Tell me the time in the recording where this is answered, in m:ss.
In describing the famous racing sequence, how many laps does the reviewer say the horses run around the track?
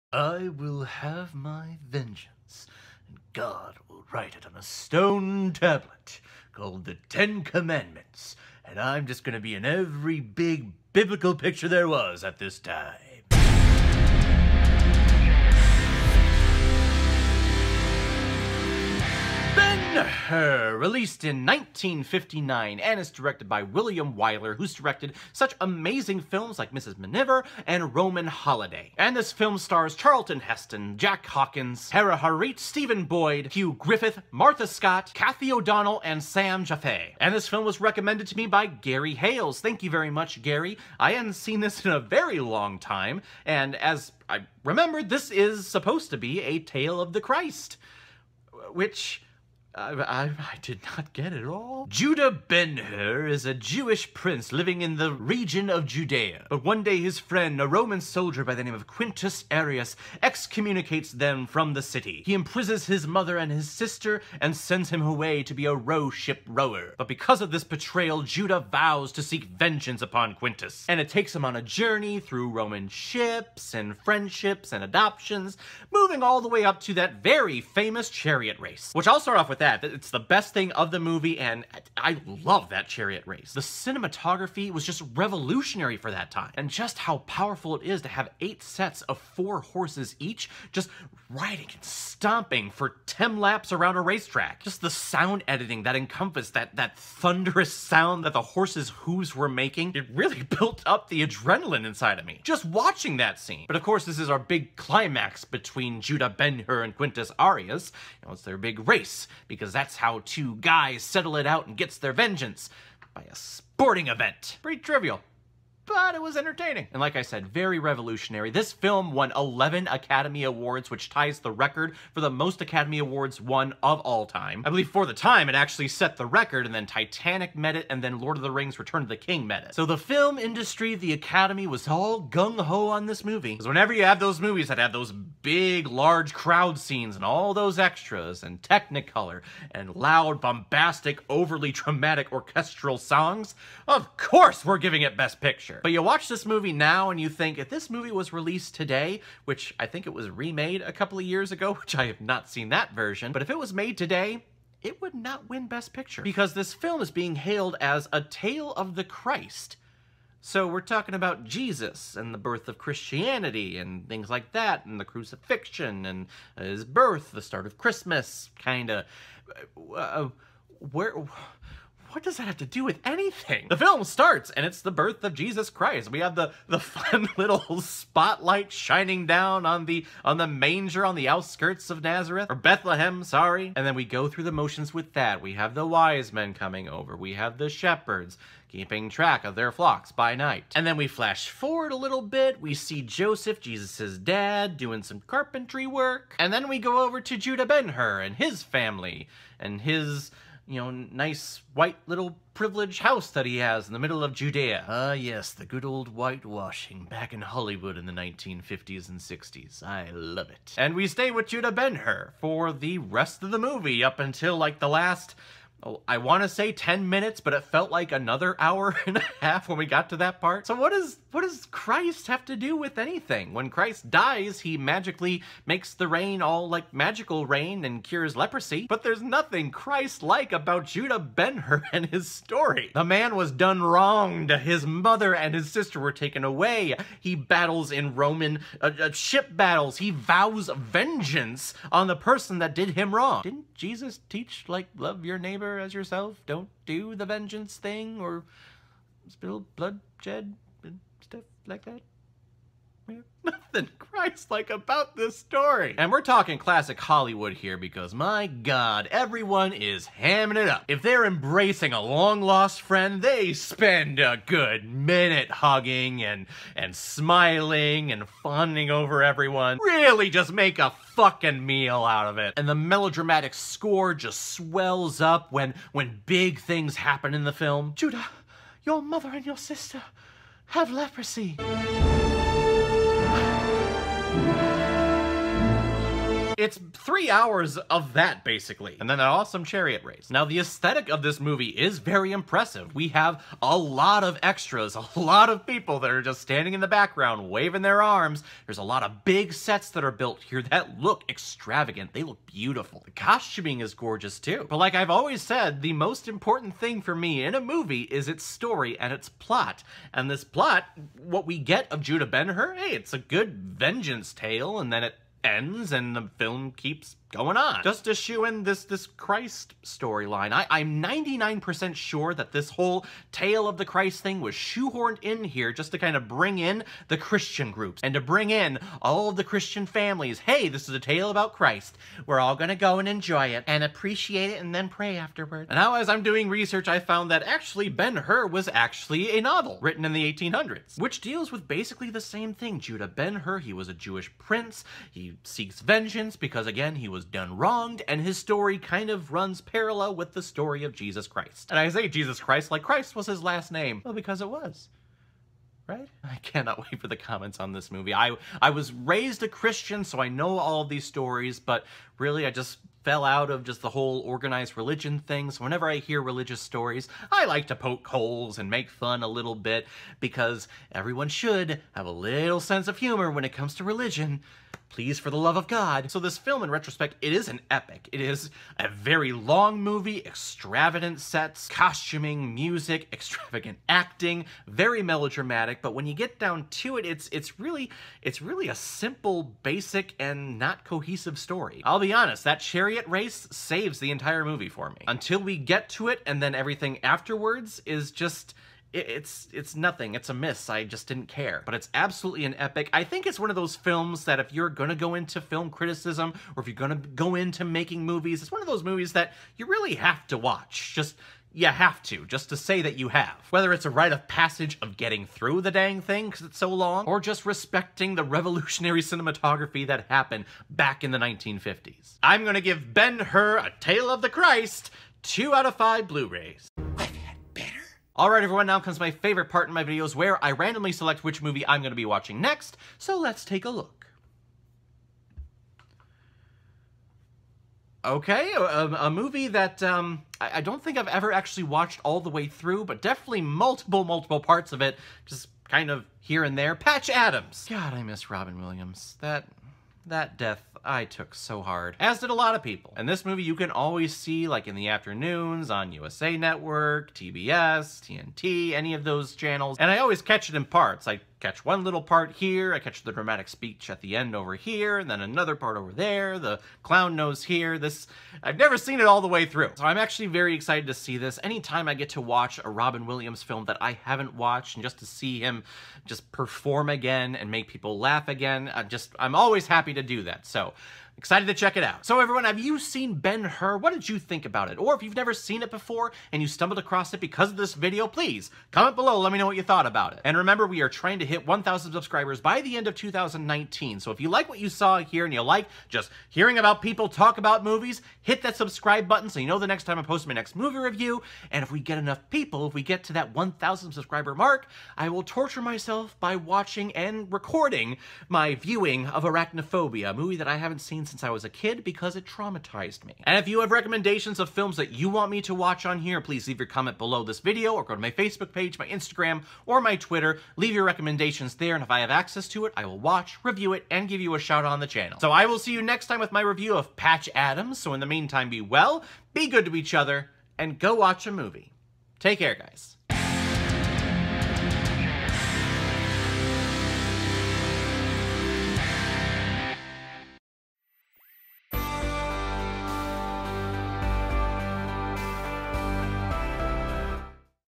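1:33.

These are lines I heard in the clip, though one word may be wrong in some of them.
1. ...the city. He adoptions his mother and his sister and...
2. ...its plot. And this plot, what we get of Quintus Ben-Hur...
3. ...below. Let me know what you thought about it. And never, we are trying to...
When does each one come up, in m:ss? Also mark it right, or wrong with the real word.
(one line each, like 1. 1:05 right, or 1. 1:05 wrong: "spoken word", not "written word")
1. 1:01 wrong: "imprisons", not "adoptions"
2. 5:09 wrong: "Judah", not "Quintus"
3. 8:08 wrong: "remember", not "never".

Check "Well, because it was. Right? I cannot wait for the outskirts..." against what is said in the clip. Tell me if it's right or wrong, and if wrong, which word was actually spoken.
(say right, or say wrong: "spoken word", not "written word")
wrong: "comments", not "outskirts".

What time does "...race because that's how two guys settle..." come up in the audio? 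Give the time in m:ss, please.
1:48.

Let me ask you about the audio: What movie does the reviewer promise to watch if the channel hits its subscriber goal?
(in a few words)
Arachnophobia.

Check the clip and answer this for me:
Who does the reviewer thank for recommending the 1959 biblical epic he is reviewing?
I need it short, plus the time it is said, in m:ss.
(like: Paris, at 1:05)
Gary Hales, at 0:38.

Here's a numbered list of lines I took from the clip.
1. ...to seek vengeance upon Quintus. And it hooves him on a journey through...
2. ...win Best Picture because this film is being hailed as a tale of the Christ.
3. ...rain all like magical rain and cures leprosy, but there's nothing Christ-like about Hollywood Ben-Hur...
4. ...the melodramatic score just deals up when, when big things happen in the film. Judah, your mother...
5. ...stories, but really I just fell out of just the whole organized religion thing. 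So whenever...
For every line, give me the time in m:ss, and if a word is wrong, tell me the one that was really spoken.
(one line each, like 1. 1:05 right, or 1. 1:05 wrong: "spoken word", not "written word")
1. 1:09 wrong: "takes", not "hooves"
2. 2:35 right
3. 3:46 wrong: "Judah", not "Hollywood"
4. 4:32 wrong: "swells", not "deals"
5. 6:01 right.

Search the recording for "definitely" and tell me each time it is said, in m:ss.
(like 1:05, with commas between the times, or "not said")
7:23.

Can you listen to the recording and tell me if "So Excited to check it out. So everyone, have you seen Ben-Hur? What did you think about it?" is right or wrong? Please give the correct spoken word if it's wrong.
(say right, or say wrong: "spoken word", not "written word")
right.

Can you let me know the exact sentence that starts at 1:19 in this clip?
It's the best thing of the movie, and I love that chariot race.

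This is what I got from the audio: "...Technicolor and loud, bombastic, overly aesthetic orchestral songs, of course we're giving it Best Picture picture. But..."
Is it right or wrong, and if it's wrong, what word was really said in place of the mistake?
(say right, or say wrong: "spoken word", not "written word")
wrong: "dramatic", not "aesthetic".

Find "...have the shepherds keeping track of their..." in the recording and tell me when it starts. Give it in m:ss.
3:07.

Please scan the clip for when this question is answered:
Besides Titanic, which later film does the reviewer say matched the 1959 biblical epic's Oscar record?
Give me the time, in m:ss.
2:08.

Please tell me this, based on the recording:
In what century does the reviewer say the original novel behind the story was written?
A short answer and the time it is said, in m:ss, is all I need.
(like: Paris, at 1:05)
1800s, at 5:40.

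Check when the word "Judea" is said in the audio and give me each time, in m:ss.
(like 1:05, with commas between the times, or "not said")
0:55, 3:24.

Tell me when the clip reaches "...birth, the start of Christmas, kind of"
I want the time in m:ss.
2:46.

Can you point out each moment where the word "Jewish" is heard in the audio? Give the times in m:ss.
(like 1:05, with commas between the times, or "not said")
0:53, 5:43.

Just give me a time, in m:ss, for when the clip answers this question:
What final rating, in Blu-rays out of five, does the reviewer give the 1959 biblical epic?
7:05.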